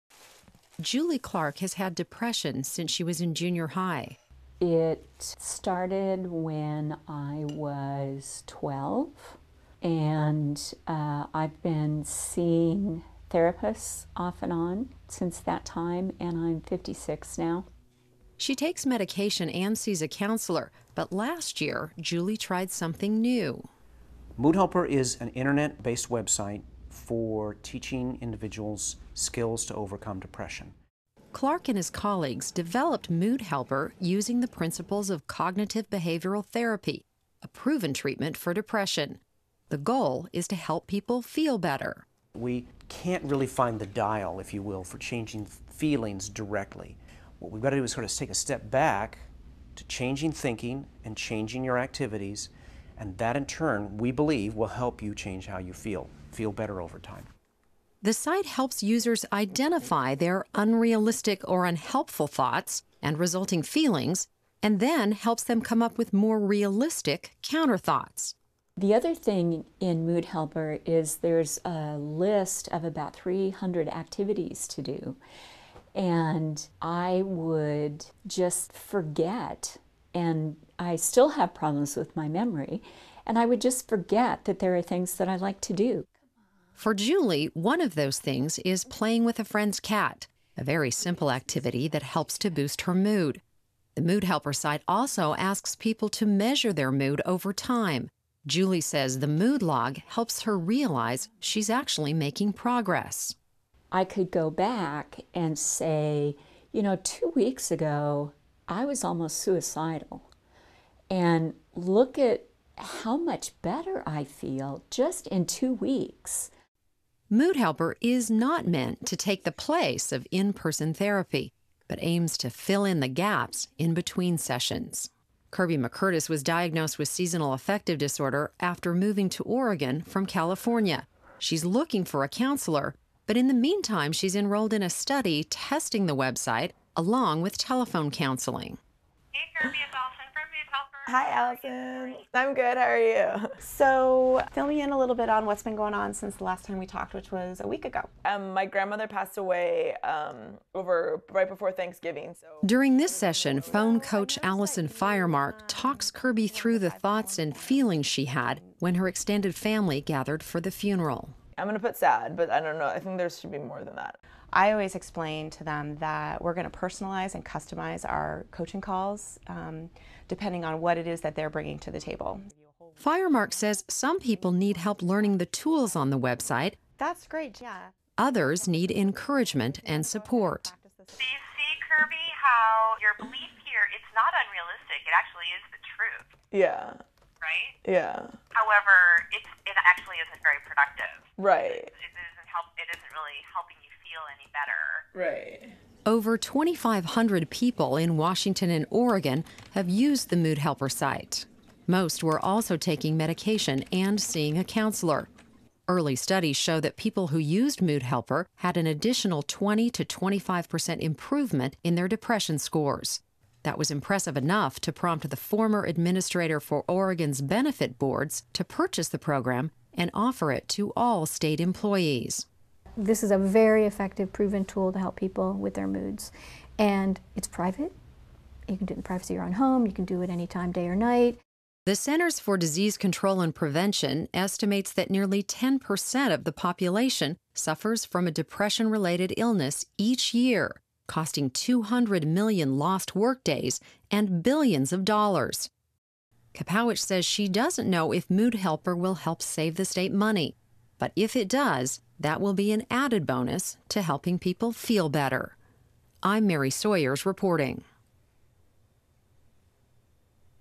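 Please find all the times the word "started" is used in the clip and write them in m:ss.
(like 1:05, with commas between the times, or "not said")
0:05.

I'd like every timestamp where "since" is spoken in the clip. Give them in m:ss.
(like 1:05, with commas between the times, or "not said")
0:02, 0:15, 2:26.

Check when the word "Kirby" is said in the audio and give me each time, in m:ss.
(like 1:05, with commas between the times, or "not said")
2:05, 2:19, 2:36, 3:01.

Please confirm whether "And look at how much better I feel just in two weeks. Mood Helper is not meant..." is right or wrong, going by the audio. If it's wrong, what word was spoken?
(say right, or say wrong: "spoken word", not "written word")
right.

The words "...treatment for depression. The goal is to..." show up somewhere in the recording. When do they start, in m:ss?
0:37.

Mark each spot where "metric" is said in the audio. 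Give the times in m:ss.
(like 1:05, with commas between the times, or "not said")
not said.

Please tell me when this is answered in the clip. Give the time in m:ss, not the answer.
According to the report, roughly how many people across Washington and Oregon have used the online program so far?
3:16.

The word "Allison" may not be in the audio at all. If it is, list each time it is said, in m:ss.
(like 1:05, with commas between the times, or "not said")
2:21, 2:34.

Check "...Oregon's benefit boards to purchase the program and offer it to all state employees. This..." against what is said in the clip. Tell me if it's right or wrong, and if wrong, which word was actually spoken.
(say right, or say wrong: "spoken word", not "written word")
right.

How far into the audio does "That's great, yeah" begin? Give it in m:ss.
2:56.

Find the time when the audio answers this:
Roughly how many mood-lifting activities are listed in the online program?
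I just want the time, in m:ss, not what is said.
1:13.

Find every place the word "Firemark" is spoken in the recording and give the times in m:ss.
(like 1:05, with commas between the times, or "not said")
2:34, 2:53.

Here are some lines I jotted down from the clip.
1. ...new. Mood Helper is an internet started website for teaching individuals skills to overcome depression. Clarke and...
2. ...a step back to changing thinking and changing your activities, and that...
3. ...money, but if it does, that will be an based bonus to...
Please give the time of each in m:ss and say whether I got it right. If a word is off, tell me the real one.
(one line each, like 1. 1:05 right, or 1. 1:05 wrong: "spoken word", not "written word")
1. 0:23 wrong: "based", not "started"
2. 0:48 right
3. 4:10 wrong: "added", not "based".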